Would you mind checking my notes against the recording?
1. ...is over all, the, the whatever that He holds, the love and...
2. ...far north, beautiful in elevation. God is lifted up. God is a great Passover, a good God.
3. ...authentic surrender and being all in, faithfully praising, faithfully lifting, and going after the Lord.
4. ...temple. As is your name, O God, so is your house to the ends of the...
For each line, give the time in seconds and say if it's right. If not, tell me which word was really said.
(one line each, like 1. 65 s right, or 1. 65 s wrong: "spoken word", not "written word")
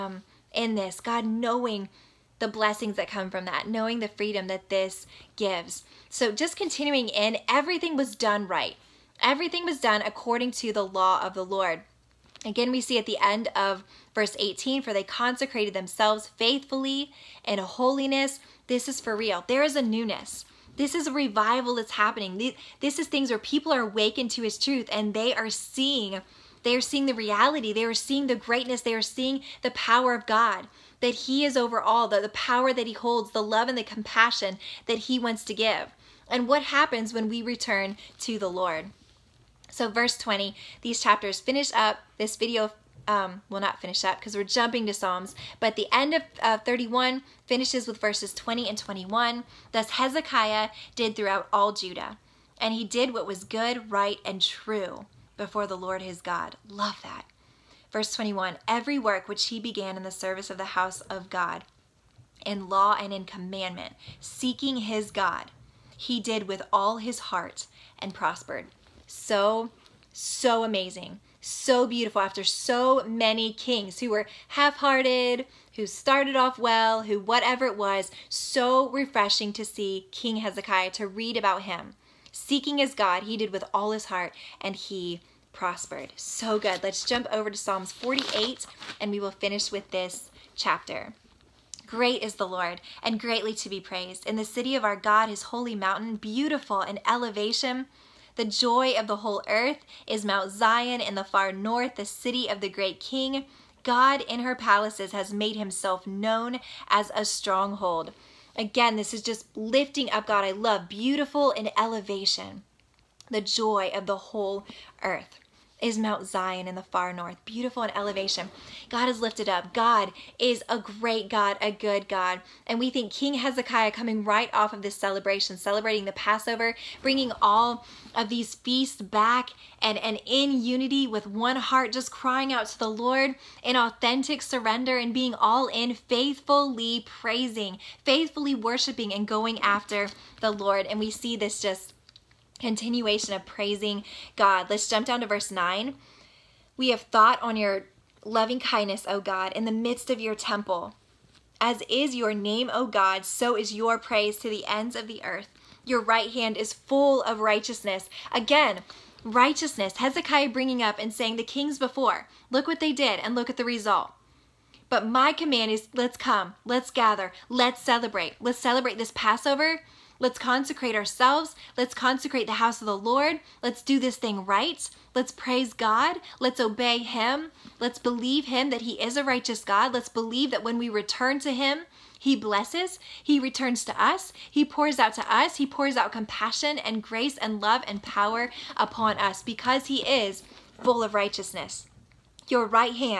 1. 31 s wrong: "power", not "whatever"
2. 116 s wrong: "God", not "Passover"
3. 133 s wrong: "worshiping", not "lifting"
4. 150 s wrong: "praise", not "house".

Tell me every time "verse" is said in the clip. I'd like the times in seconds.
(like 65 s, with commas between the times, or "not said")
14 s, 39 s, 47 s, 57 s, 145 s.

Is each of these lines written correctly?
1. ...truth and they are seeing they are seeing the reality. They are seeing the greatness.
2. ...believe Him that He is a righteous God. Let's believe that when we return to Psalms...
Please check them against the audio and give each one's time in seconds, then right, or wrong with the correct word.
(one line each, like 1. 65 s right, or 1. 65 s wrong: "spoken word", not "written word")
1. 24 s right
2. 177 s wrong: "Him", not "Psalms".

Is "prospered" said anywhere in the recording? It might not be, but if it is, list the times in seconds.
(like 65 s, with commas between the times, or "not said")
68 s, 85 s.